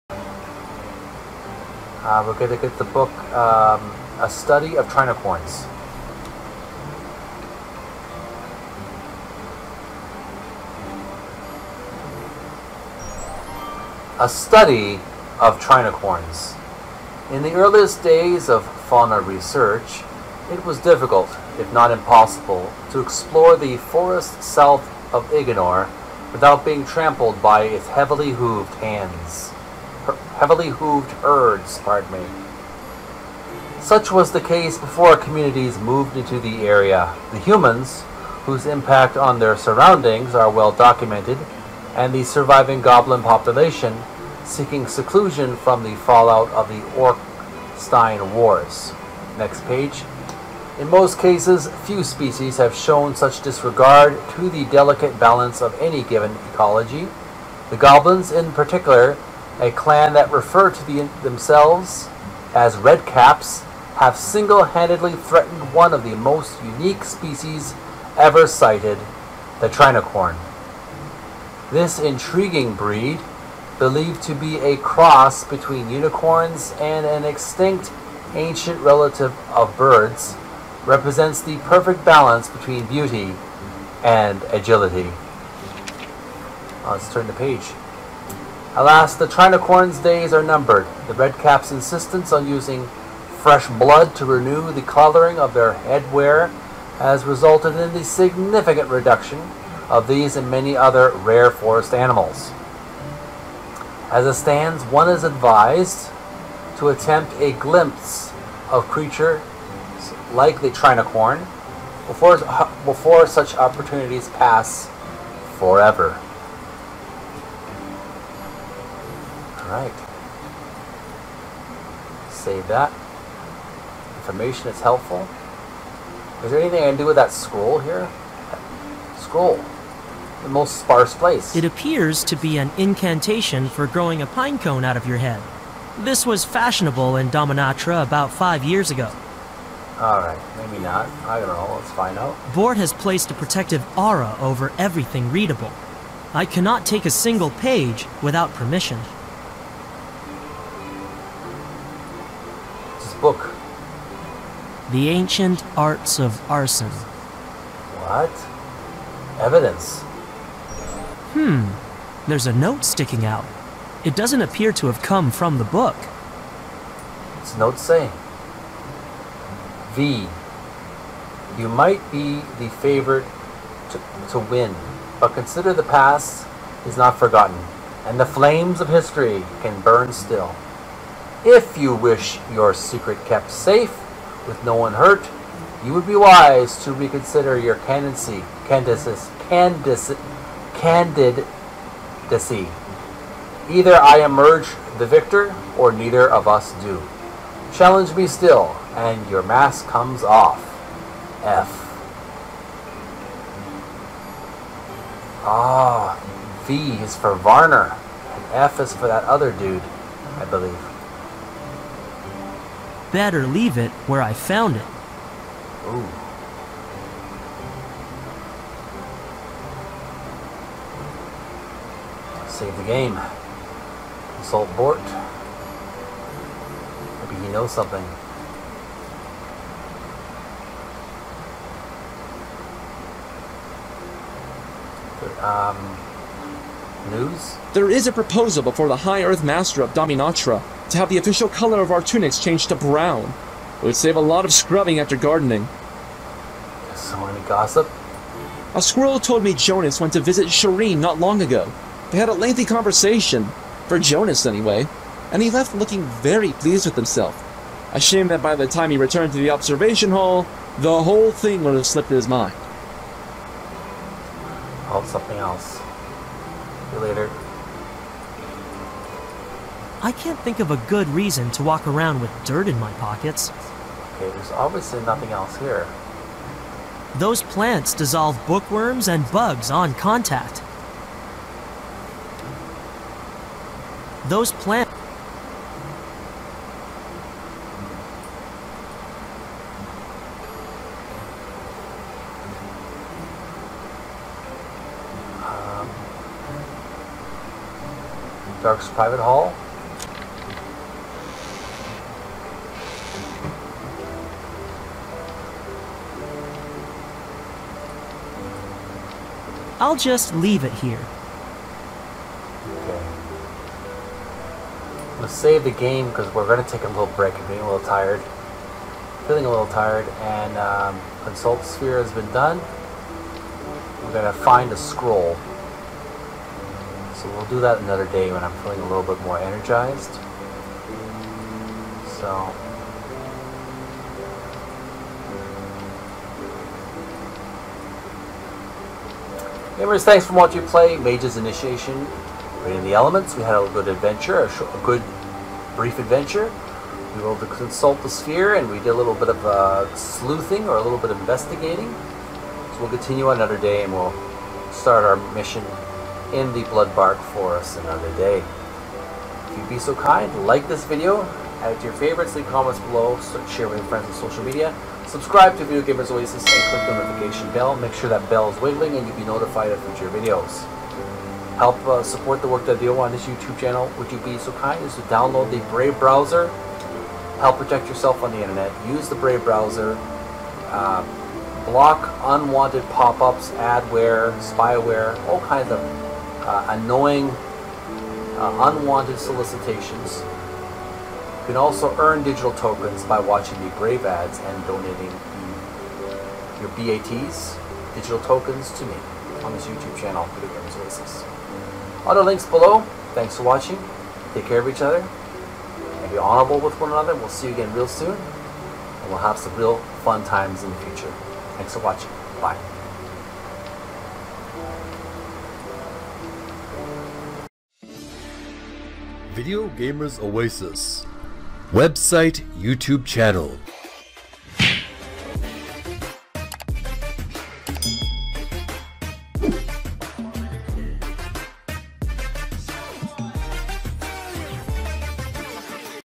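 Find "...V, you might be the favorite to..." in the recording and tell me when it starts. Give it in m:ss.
2:49.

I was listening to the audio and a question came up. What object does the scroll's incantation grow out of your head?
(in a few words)
a pine cone.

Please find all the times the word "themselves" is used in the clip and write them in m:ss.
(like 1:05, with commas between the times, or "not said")
1:01.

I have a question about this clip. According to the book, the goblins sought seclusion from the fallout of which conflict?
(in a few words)
Orkstein Wars.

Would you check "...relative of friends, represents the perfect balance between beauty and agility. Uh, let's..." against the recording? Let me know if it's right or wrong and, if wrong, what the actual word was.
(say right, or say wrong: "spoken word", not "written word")
wrong: "birds", not "friends".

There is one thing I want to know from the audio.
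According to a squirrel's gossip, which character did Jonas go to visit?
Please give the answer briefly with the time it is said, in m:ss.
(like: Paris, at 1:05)
Shireen, at 4:10.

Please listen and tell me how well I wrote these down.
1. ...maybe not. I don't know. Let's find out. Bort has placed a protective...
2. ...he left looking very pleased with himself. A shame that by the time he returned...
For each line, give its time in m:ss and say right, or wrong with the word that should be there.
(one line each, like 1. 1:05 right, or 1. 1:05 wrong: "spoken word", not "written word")
1. 2:20 right
2. 4:15 right.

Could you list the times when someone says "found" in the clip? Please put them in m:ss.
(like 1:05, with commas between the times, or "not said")
3:34.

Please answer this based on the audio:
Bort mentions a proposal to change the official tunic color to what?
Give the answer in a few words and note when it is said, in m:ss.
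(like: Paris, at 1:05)
Brown, at 4:02.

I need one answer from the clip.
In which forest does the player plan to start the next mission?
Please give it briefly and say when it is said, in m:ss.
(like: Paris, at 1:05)
Blood Bark Forest, at 5:56.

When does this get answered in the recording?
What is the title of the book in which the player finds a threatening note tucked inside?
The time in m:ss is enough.
2:34.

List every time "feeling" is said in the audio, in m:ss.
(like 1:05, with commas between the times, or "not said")
5:19, 5:28.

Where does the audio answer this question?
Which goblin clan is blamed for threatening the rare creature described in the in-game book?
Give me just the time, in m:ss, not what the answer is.
1:02.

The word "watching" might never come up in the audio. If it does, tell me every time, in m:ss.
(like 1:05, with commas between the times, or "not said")
5:40, 6:33, 6:43, 6:51.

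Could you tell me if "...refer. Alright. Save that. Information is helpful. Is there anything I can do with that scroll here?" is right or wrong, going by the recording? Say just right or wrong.
wrong.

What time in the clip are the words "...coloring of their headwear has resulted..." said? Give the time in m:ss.
1:34.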